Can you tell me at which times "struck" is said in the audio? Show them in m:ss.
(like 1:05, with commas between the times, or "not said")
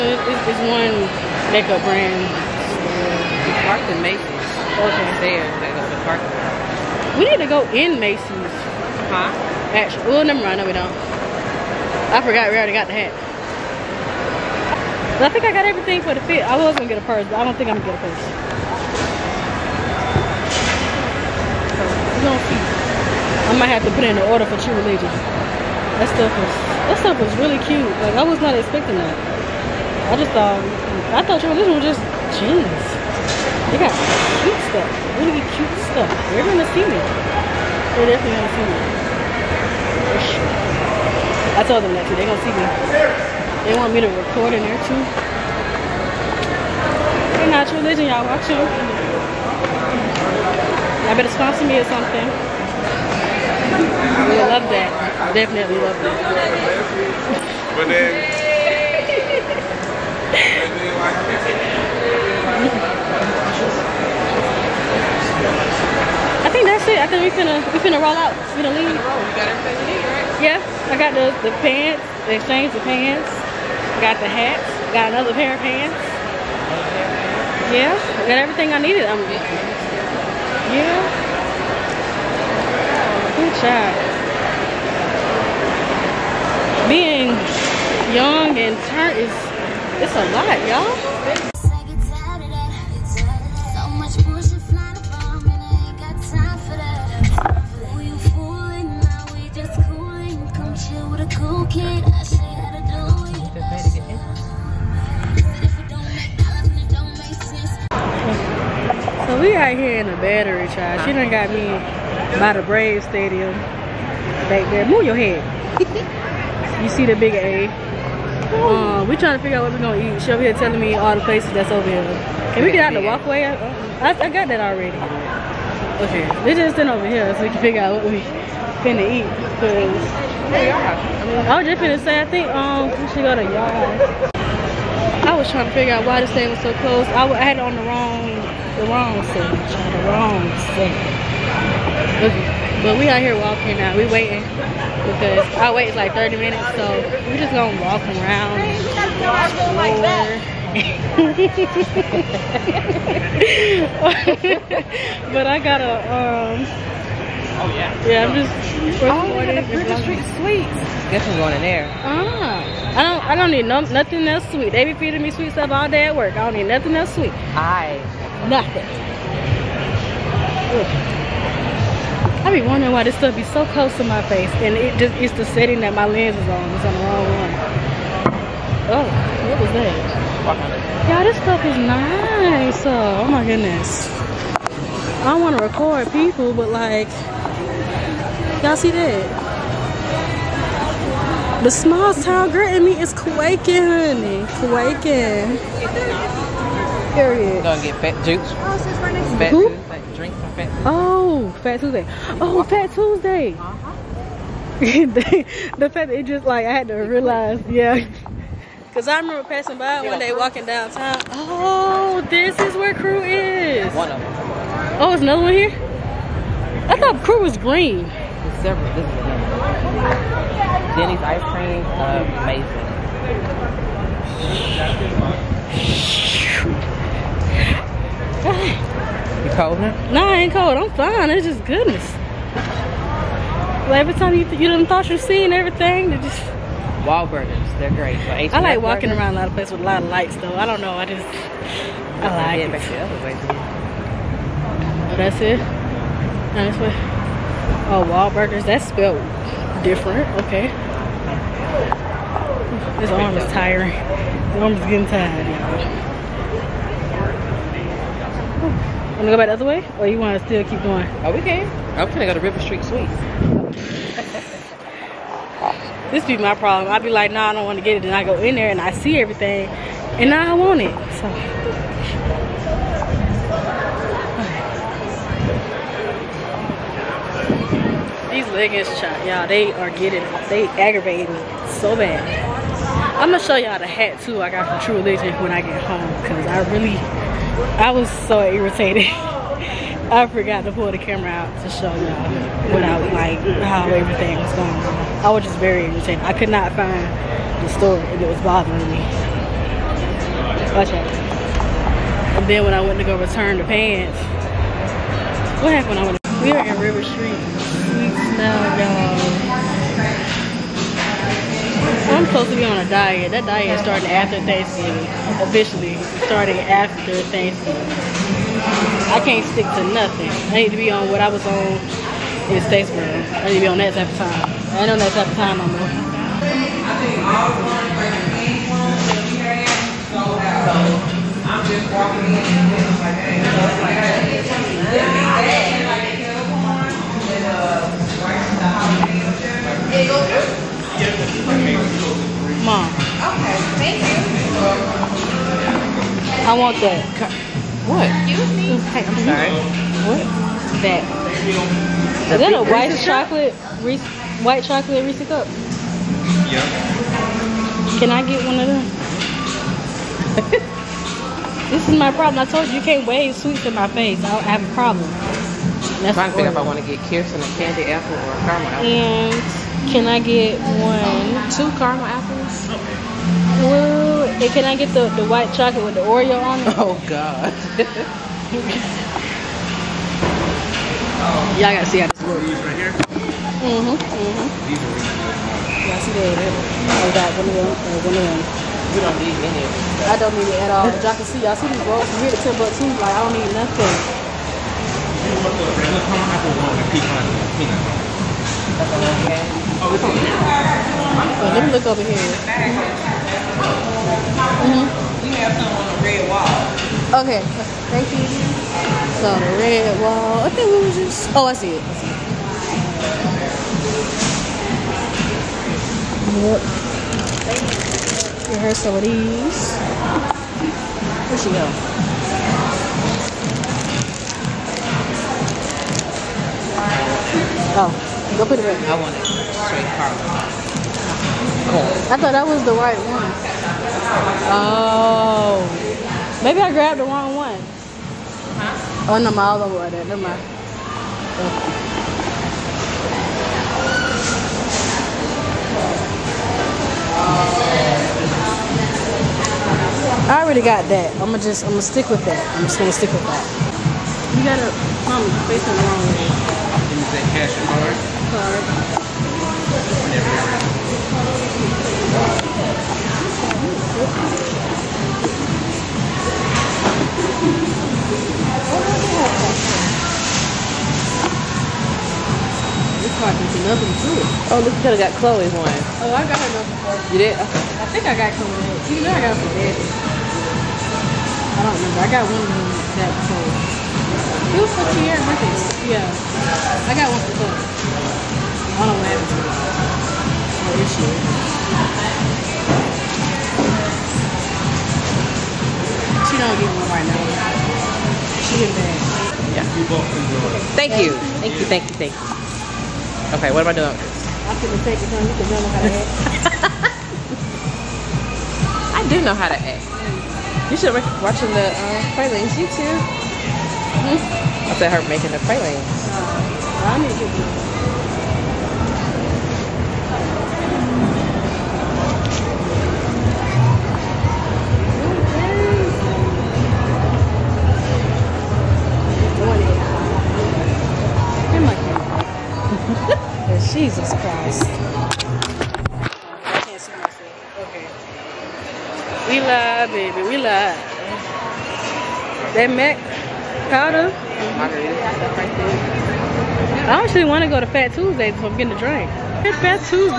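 not said.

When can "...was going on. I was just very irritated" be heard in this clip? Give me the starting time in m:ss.
4:54.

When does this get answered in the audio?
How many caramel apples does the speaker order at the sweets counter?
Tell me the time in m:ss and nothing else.
6:11.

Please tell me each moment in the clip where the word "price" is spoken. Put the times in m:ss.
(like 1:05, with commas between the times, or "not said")
not said.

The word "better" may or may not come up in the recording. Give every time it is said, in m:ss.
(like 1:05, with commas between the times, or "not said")
0:51.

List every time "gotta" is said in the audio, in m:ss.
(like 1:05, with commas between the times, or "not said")
2:35, 6:21, 7:34.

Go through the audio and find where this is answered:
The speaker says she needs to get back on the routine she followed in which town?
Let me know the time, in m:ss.
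5:22.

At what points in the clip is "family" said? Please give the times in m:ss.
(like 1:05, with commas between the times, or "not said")
not said.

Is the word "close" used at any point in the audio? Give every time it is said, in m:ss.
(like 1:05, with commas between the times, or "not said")
2:16, 2:53.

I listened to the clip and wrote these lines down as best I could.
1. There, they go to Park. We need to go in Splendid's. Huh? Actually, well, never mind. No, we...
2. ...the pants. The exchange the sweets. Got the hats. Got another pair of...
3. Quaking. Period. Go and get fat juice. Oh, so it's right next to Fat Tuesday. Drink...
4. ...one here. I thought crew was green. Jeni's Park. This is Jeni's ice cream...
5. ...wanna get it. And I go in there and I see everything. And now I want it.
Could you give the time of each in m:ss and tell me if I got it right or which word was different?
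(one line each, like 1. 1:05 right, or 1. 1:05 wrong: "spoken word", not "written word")
1. 0:05 wrong: "Macy", not "Splendid"
2. 1:11 wrong: "pants", not "sweets"
3. 3:14 right
4. 3:35 wrong: "Splendid", not "Park"
5. 4:27 right.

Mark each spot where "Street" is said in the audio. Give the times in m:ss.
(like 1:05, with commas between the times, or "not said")
2:40, 4:22, 5:07.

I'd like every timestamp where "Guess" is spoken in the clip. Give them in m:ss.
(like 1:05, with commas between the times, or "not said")
2:41.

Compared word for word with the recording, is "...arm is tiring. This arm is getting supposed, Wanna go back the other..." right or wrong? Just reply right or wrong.
wrong.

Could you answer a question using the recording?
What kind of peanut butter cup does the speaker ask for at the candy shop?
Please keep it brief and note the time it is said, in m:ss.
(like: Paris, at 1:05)
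white chocolate Reese cup, at 5:54.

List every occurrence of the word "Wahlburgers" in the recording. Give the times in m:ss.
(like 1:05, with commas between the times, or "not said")
3:57, 4:08.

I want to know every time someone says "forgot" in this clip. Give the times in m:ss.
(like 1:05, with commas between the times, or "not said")
0:12, 4:50.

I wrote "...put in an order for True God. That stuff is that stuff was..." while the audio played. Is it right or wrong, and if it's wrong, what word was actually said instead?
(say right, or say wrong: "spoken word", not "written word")
wrong: "Religion", not "God".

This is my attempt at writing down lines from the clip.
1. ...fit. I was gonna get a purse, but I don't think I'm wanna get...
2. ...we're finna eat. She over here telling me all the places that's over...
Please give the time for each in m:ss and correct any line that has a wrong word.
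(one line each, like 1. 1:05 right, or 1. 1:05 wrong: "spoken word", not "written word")
1. 0:16 wrong: "gonna", not "wanna"
2. 1:59 wrong: "gonna", not "finna".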